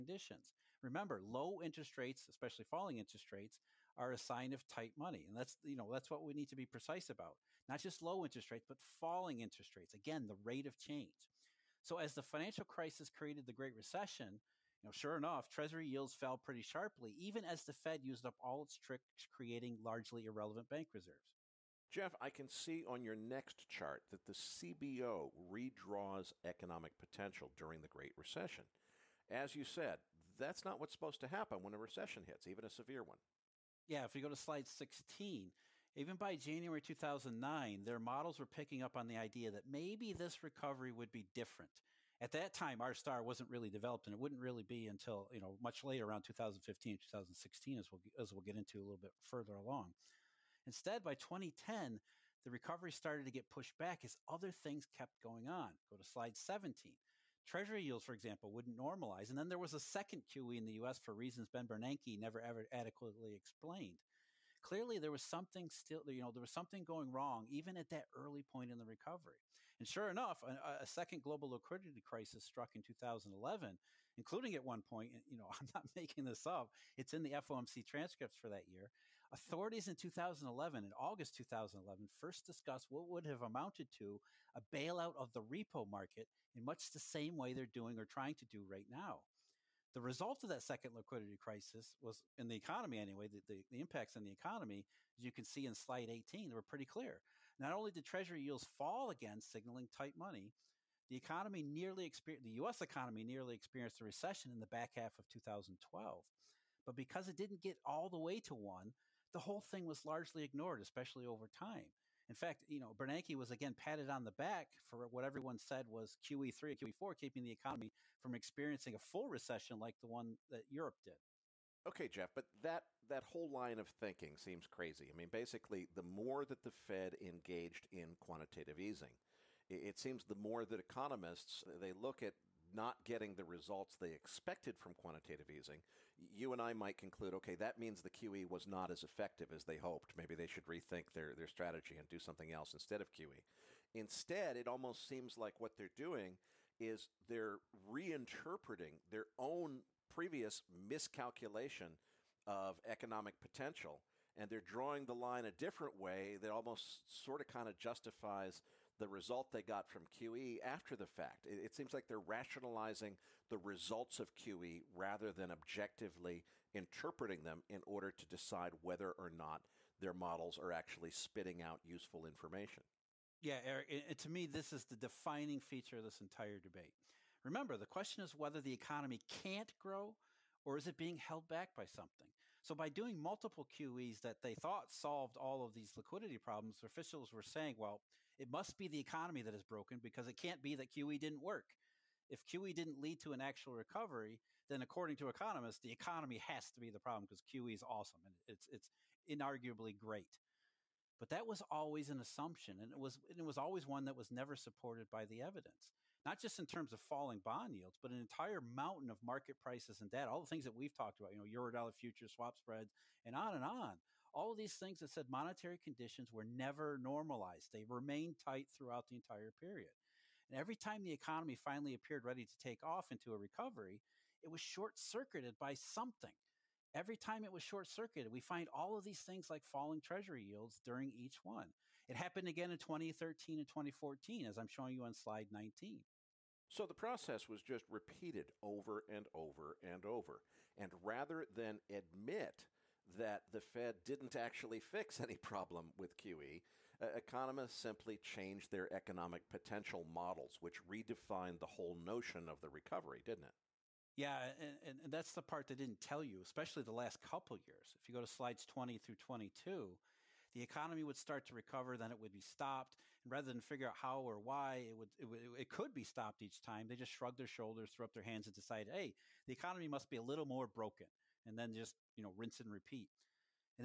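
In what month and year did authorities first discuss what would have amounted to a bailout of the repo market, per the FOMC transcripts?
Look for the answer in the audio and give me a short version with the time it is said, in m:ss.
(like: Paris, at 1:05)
August 2011, at 1:20.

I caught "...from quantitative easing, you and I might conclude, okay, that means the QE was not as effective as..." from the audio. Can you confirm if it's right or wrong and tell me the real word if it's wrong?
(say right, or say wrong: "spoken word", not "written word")
right.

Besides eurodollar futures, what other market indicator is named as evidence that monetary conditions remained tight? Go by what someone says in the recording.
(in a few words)
swap spreads.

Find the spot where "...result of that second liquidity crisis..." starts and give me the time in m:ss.
1:30.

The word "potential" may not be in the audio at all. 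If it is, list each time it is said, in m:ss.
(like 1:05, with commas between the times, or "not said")
0:26, 2:33, 4:09.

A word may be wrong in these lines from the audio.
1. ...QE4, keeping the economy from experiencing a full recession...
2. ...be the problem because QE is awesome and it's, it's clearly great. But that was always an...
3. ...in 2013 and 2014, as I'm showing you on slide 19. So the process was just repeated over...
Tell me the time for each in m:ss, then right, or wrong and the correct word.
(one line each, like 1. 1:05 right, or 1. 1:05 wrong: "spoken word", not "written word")
1. 1:56 right
2. 3:16 wrong: "inarguably", not "clearly"
3. 3:52 right.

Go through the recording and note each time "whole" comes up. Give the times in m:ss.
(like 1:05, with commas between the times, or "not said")
1:49, 2:03, 4:11.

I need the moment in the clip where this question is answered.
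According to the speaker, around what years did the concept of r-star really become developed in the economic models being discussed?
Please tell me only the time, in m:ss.
0:46.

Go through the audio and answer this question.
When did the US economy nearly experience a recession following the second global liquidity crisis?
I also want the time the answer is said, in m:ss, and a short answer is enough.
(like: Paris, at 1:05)
back half of 2012, at 1:44.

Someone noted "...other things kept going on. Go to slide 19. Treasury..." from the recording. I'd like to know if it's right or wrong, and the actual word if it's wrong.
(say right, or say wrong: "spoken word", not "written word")
wrong: "17", not "19".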